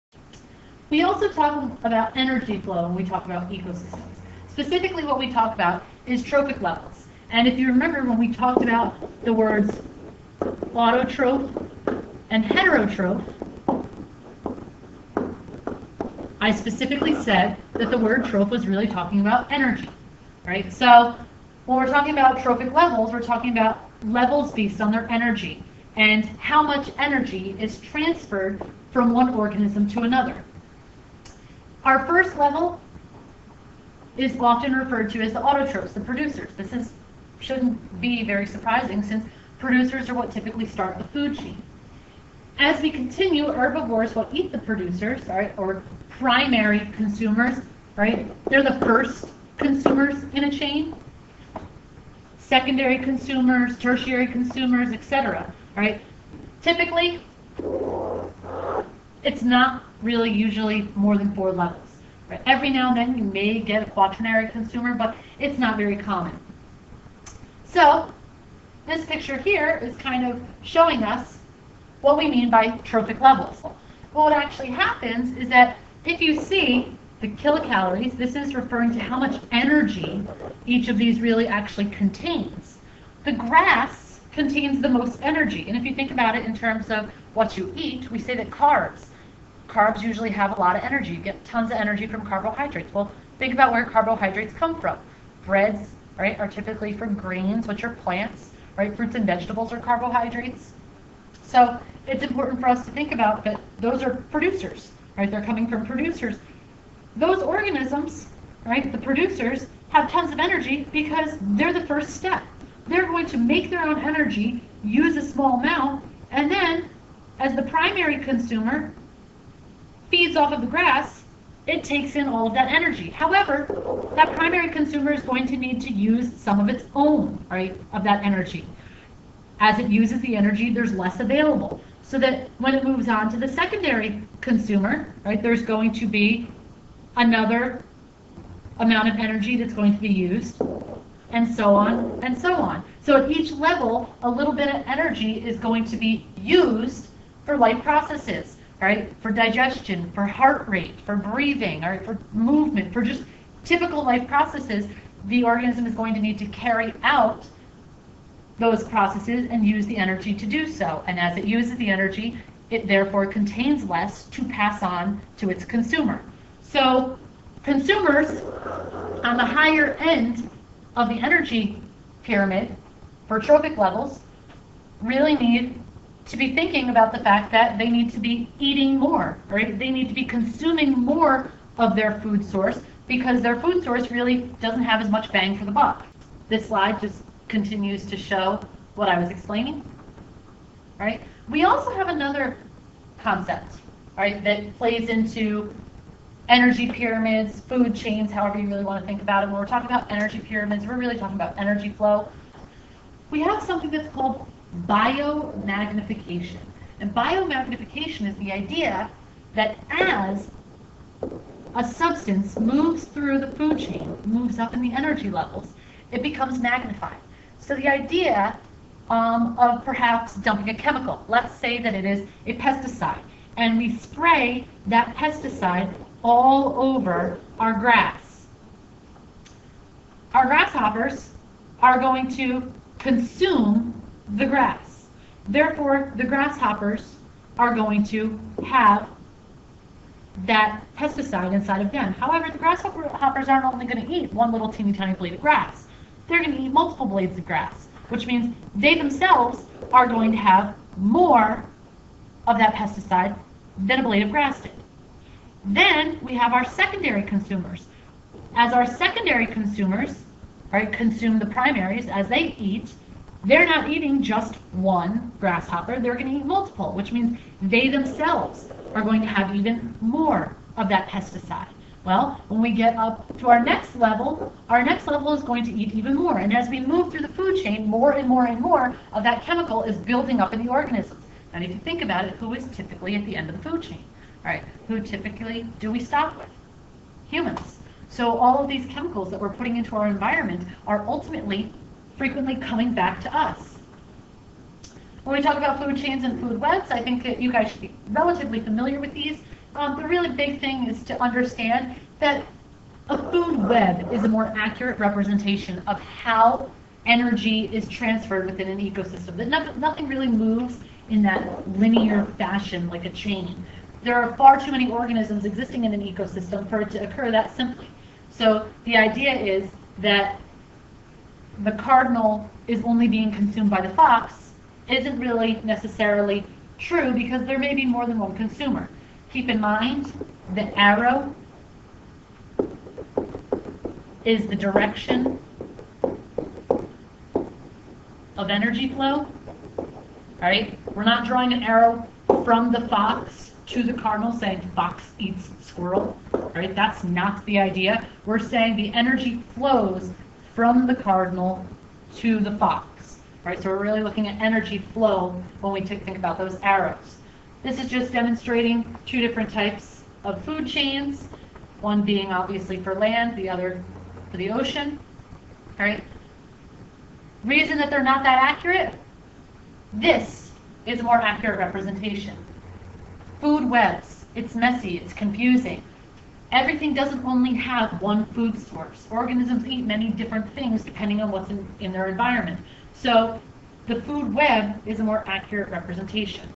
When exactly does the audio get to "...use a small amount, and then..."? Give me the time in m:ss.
1:54.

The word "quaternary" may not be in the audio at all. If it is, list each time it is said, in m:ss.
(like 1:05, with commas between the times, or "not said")
1:03.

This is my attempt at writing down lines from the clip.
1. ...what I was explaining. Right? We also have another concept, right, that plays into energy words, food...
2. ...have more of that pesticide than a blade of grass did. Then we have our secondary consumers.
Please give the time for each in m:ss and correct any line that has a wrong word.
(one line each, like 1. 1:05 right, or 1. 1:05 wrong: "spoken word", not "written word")
1. 3:08 wrong: "pyramids", not "words"
2. 4:10 right.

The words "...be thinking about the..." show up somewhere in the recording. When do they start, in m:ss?
2:56.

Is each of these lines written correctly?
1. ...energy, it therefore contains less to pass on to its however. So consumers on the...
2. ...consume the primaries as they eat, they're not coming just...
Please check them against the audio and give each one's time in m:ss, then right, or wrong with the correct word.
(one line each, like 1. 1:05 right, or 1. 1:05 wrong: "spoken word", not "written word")
1. 2:41 wrong: "consumer", not "however"
2. 4:20 wrong: "eating", not "coming".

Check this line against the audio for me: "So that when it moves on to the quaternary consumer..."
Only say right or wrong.
wrong.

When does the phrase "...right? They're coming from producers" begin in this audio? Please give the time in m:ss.
1:45.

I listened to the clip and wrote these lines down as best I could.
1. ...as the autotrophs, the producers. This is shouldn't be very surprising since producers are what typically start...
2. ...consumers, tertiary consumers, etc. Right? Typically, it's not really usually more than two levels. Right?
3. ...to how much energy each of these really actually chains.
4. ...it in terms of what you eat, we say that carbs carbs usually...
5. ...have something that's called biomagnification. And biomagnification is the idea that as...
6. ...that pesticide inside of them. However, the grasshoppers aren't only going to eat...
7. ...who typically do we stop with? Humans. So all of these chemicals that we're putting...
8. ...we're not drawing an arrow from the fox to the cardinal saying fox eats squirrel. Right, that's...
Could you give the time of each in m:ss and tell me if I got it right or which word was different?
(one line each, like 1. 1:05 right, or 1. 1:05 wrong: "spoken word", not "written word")
1. 0:35 right
2. 0:52 wrong: "four", not "two"
3. 1:18 wrong: "contains", not "chains"
4. 1:26 right
5. 3:23 right
6. 4:00 right
7. 4:44 right
8. 5:40 right.